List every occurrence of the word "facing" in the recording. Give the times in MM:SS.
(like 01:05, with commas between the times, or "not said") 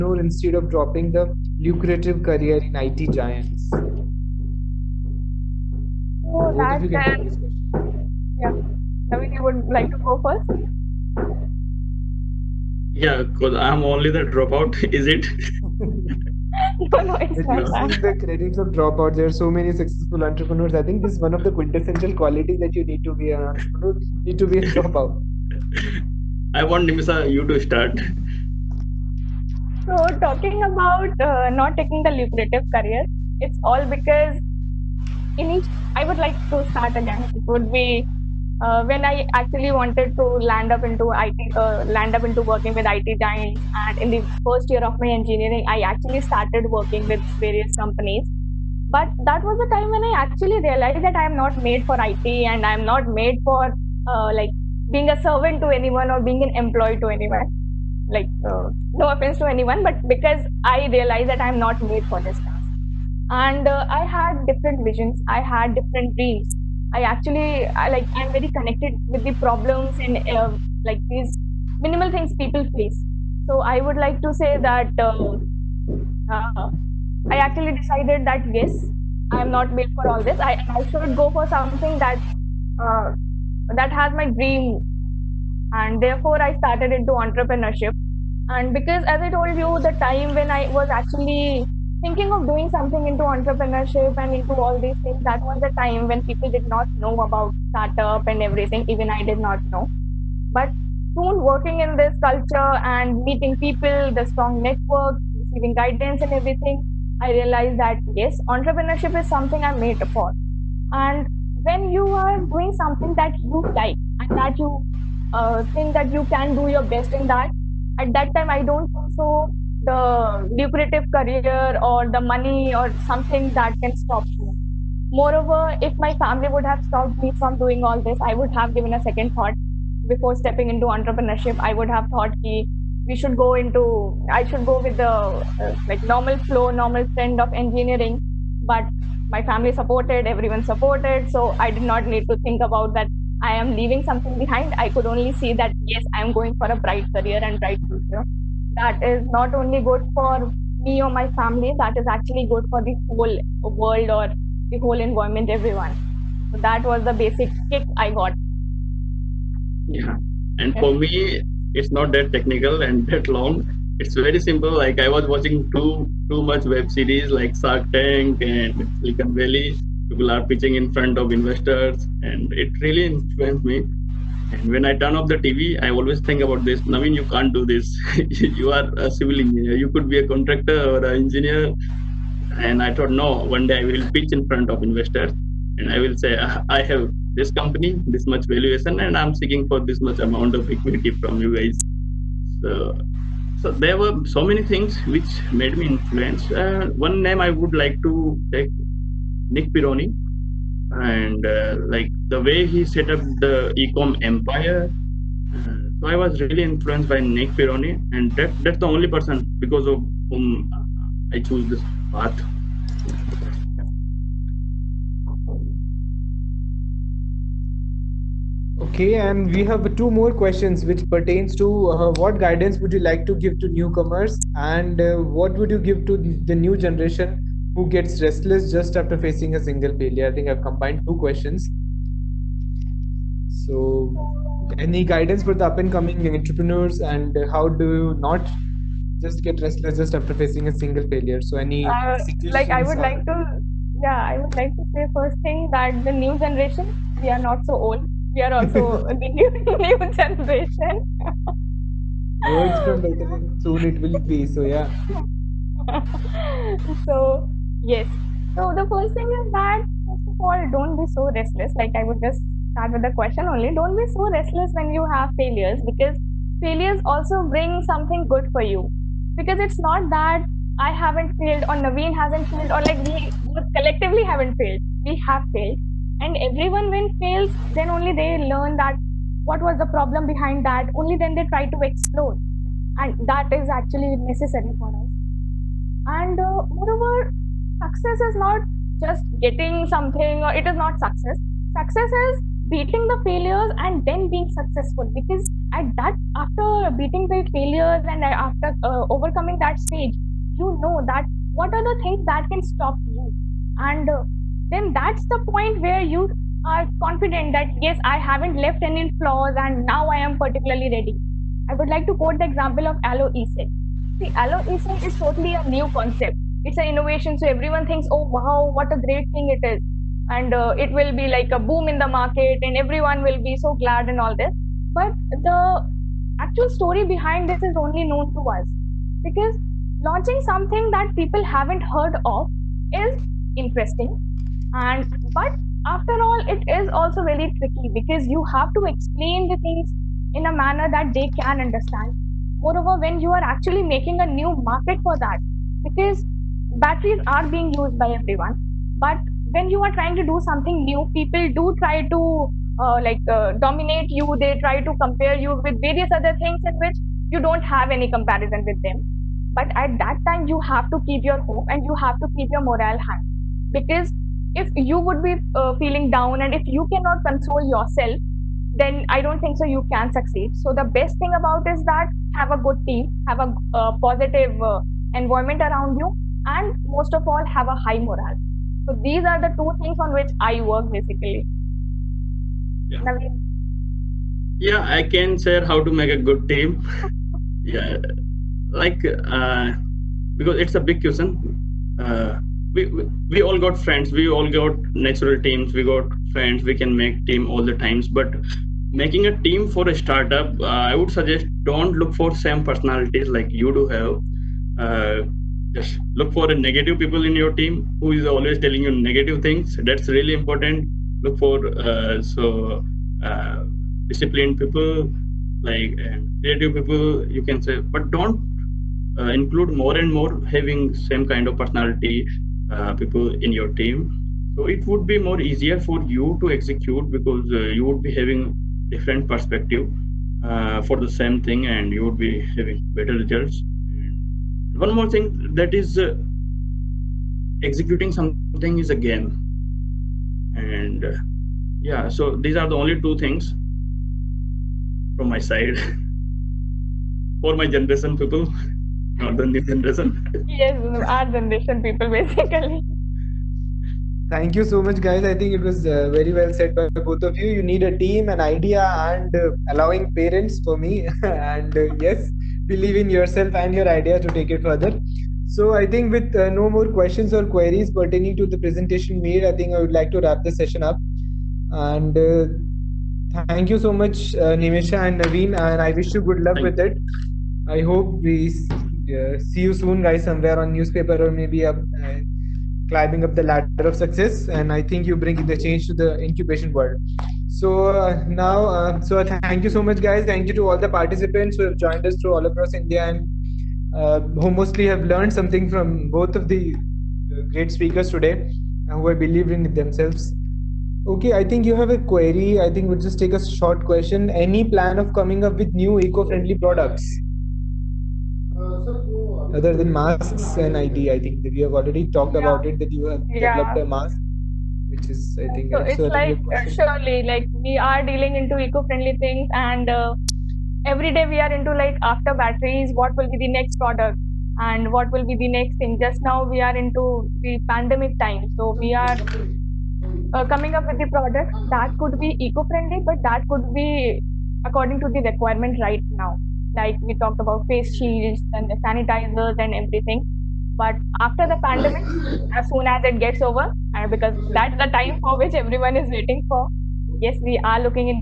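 03:49, 04:00.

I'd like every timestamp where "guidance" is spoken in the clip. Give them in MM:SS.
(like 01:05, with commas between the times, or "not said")
01:45, 03:42, 03:55.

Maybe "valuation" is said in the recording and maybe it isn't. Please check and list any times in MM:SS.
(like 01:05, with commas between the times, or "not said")
03:08.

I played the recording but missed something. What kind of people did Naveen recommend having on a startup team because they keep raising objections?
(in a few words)
Negative people.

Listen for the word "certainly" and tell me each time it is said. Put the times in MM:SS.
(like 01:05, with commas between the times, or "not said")
not said.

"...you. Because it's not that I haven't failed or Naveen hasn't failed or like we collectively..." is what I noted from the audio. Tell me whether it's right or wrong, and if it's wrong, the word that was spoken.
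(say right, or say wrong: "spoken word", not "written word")
right.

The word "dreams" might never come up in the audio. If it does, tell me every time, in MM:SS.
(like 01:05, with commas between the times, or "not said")
01:06, 01:24.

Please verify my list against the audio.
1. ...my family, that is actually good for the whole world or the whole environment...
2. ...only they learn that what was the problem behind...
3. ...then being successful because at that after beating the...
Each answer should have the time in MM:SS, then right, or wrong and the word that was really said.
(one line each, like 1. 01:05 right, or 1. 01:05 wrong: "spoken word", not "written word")
1. 02:31 right
2. 04:37 right
3. 04:54 right.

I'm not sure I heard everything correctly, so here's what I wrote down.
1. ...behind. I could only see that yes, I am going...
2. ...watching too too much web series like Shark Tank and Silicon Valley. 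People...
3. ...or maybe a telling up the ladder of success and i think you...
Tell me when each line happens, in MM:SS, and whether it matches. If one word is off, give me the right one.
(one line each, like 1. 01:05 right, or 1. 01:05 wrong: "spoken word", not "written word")
1. 02:24 right
2. 02:45 right
3. 08:01 wrong: "climbing", not "telling".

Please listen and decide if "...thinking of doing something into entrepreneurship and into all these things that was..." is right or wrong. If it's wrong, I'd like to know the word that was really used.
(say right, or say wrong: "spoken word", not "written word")
right.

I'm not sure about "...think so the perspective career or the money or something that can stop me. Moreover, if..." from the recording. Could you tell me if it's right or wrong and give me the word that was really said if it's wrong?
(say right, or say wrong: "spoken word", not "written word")
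wrong: "lucrative", not "perspective".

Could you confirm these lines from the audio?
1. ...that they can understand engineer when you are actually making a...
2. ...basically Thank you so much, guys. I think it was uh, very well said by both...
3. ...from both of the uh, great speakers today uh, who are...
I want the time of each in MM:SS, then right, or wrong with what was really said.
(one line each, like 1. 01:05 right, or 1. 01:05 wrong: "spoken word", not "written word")
1. 05:40 wrong: "moreover", not "engineer"
2. 07:32 right
3. 08:15 right.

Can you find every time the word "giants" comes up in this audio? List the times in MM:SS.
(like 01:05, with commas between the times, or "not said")
00:03, 00:43.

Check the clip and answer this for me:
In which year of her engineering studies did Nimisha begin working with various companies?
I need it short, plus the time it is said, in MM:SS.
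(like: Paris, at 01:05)
First year, at 00:44.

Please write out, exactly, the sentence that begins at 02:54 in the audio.
And when I turn off the TV, I always think about this.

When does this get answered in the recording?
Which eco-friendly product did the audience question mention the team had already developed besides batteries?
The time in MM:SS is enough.
08:33.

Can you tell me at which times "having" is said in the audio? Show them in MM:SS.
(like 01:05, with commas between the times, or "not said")
07:00, 07:08, 07:12.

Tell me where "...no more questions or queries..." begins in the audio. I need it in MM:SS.
07:46.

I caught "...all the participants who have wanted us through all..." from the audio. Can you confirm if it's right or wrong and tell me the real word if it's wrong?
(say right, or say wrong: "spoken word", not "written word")
wrong: "joined", not "wanted".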